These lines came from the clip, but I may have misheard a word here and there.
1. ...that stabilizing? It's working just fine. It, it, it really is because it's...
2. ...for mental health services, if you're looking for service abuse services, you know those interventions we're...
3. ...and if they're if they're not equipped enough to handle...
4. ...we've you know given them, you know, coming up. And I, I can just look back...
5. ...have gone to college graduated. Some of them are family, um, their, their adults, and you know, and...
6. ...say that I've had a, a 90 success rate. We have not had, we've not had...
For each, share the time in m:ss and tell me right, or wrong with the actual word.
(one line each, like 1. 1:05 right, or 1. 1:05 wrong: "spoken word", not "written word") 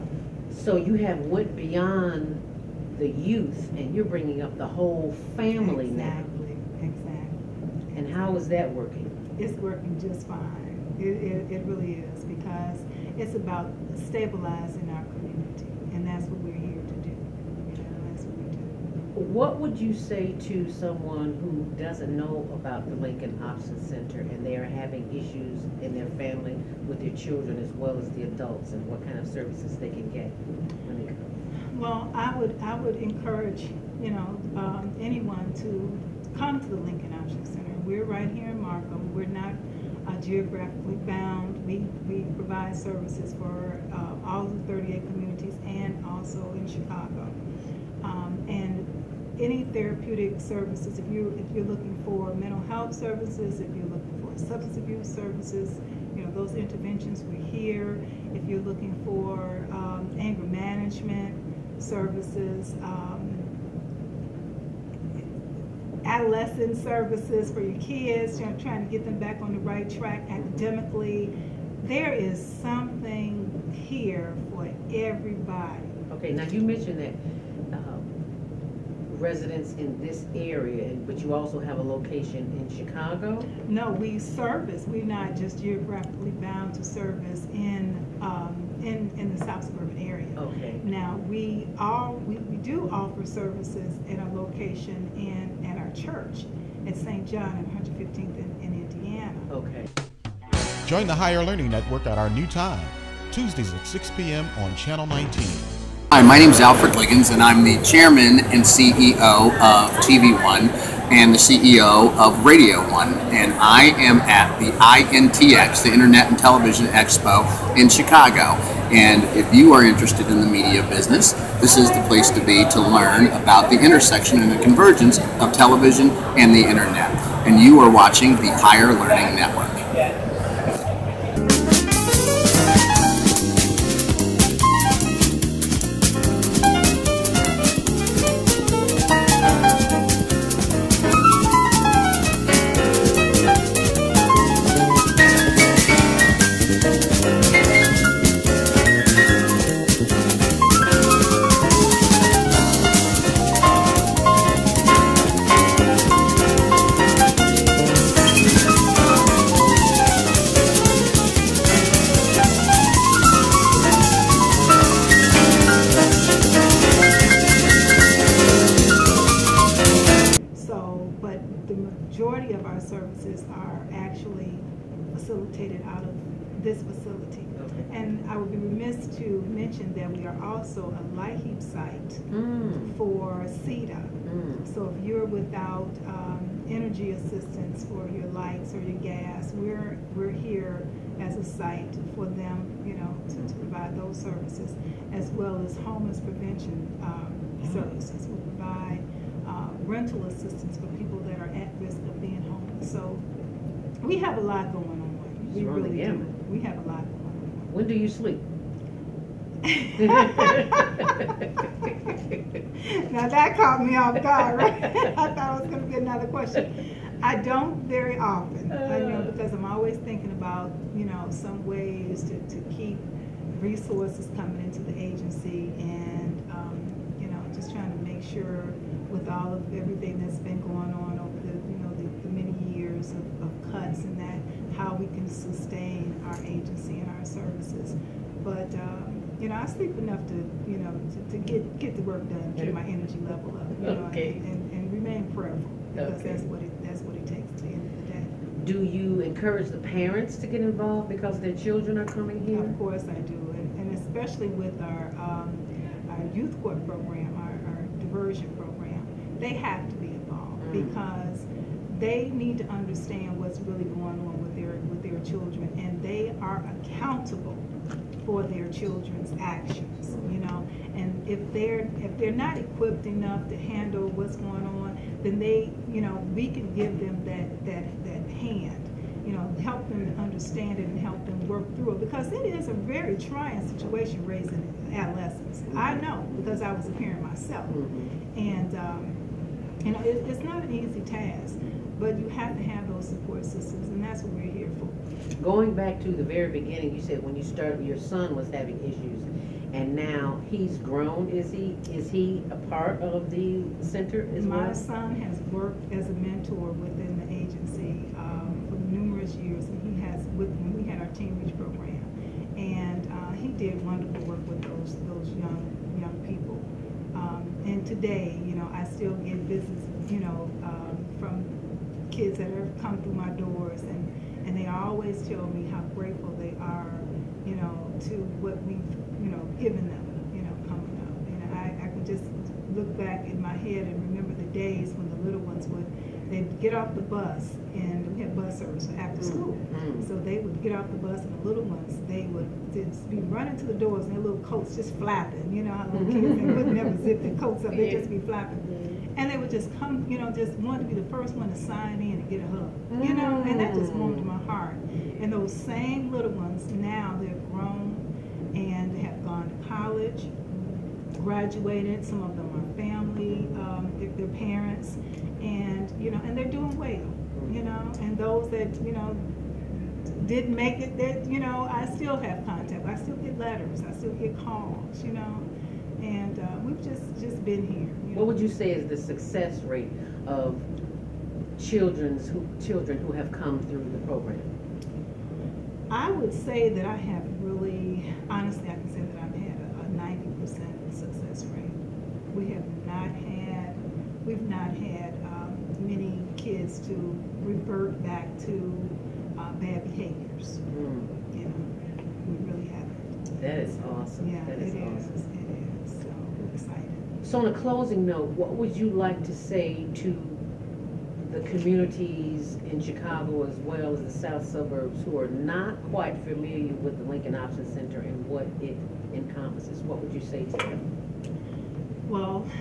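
1. 0:08 wrong: "working", not "stabilizing"
2. 0:52 wrong: "substance", not "service"
3. 4:30 right
4. 5:28 right
5. 5:59 wrong: "parents", not "adults"
6. 6:28 right.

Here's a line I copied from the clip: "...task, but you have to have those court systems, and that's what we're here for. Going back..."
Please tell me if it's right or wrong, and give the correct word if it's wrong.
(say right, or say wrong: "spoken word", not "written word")
wrong: "support", not "court".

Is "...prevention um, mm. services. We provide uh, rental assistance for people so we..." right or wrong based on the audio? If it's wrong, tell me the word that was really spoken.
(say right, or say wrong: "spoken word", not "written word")
right.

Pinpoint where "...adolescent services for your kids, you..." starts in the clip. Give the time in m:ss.
1:06.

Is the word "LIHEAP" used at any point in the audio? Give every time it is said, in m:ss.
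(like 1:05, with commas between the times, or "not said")
3:01.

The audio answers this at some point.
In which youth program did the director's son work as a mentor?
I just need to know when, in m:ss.
5:11.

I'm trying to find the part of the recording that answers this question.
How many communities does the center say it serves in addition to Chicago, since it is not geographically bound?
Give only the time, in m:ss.
0:44.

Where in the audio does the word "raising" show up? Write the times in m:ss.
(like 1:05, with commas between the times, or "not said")
4:44.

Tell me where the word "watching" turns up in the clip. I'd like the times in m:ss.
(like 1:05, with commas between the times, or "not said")
2:07.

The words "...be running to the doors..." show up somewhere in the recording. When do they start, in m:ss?
5:43.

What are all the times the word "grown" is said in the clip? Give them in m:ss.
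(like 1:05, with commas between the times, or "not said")
5:00, 5:57.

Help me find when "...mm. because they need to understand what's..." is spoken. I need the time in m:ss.
4:20.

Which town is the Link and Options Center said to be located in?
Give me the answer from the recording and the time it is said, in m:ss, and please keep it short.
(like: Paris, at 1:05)
Markham, at 0:38.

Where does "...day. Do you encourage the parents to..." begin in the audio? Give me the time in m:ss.
4:08.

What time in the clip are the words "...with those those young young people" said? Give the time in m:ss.
5:14.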